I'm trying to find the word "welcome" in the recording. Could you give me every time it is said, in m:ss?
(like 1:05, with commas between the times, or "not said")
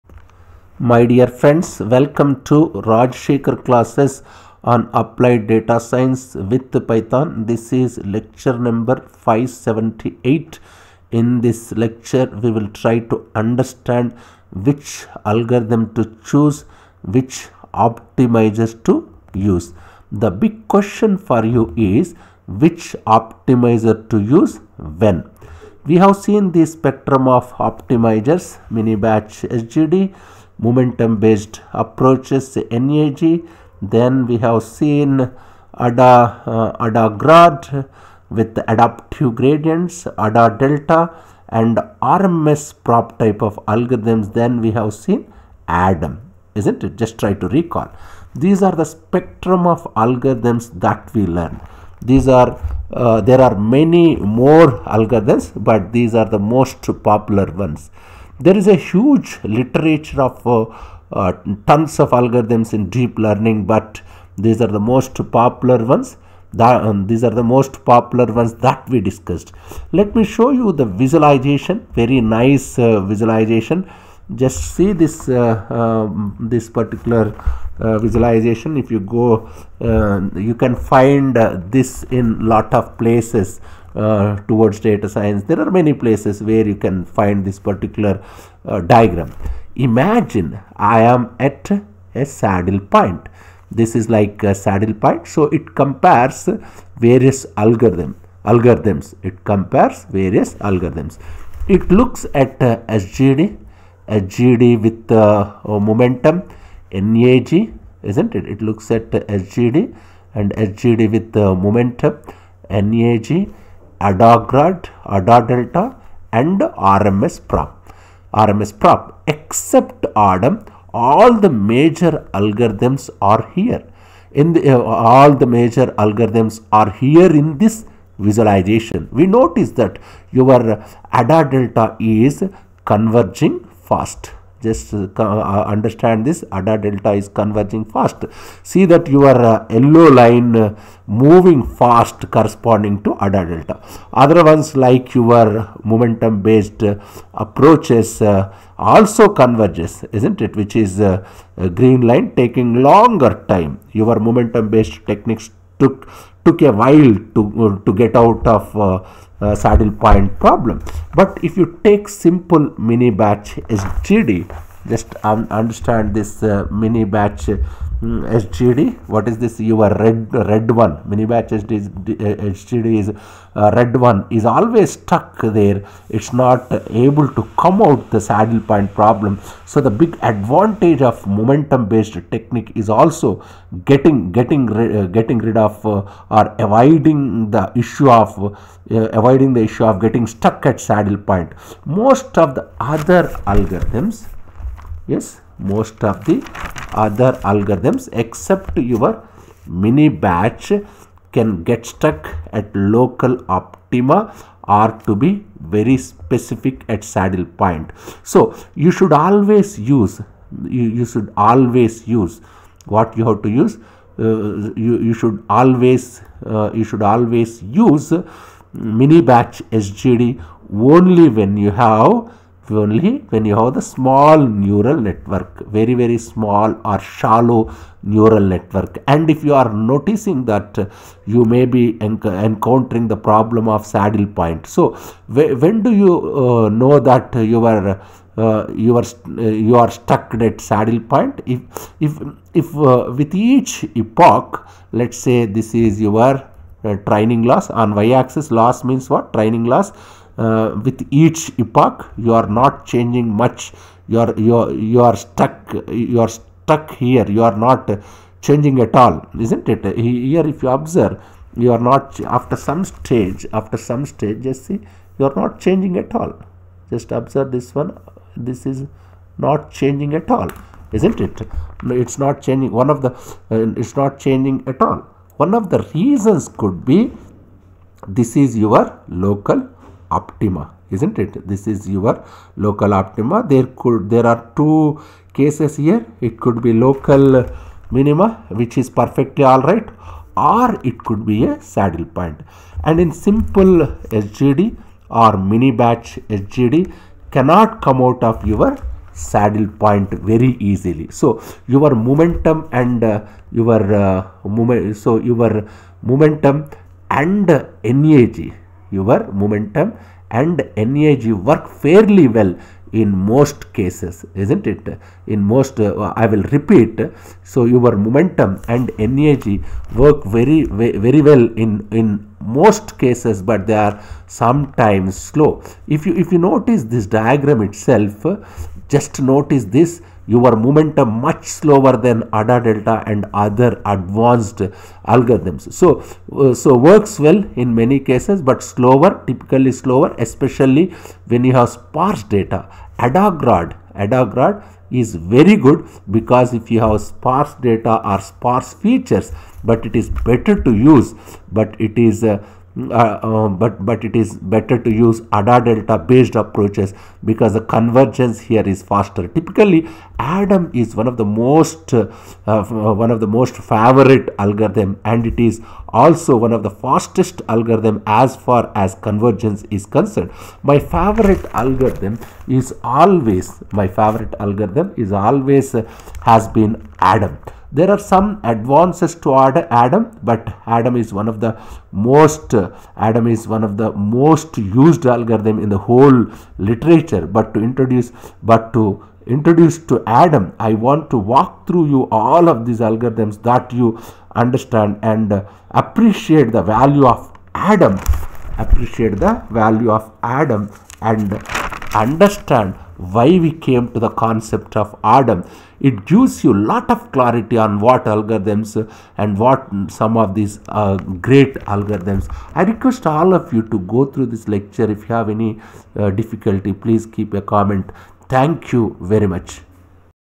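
0:01.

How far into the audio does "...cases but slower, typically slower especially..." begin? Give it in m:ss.
5:37.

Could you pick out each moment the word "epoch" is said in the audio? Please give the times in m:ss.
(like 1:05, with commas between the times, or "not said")
4:03, 4:11.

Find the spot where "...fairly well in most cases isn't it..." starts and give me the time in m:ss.
5:11.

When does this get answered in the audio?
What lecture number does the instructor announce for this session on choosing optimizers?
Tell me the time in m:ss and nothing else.
0:09.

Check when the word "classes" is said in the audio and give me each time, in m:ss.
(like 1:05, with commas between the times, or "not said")
0:03.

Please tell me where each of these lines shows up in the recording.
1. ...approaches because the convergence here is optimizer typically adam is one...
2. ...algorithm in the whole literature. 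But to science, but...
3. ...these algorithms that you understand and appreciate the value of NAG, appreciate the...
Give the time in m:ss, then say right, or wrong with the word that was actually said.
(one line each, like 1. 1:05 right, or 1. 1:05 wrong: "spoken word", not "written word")
1. 5:56 wrong: "faster", not "optimizer"
2. 6:25 wrong: "introduce", not "science"
3. 6:32 wrong: "Adam", not "NAG".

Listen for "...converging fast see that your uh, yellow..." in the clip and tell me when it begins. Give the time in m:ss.
2:17.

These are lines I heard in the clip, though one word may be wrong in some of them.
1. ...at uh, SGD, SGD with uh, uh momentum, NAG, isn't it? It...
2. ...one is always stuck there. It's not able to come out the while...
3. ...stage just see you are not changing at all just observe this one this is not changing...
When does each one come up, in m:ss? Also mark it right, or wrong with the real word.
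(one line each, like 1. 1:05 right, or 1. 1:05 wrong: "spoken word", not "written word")
1. 1:42 right
2. 2:53 wrong: "saddle", not "while"
3. 4:24 right.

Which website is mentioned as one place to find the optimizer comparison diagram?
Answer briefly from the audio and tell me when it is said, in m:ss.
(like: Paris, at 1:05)
Towards Data Science, at 1:24.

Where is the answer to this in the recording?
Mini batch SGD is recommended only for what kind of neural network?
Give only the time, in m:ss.
3:45.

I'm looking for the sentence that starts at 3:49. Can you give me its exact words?
And if you are noticing that uh, you may be encountering the problem of saddle point.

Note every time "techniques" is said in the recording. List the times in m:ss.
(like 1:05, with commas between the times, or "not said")
2:35, 3:02.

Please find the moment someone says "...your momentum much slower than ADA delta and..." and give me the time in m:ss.
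5:30.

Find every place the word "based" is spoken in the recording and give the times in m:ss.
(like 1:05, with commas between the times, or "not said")
0:31, 2:26, 2:34, 3:01, 5:56.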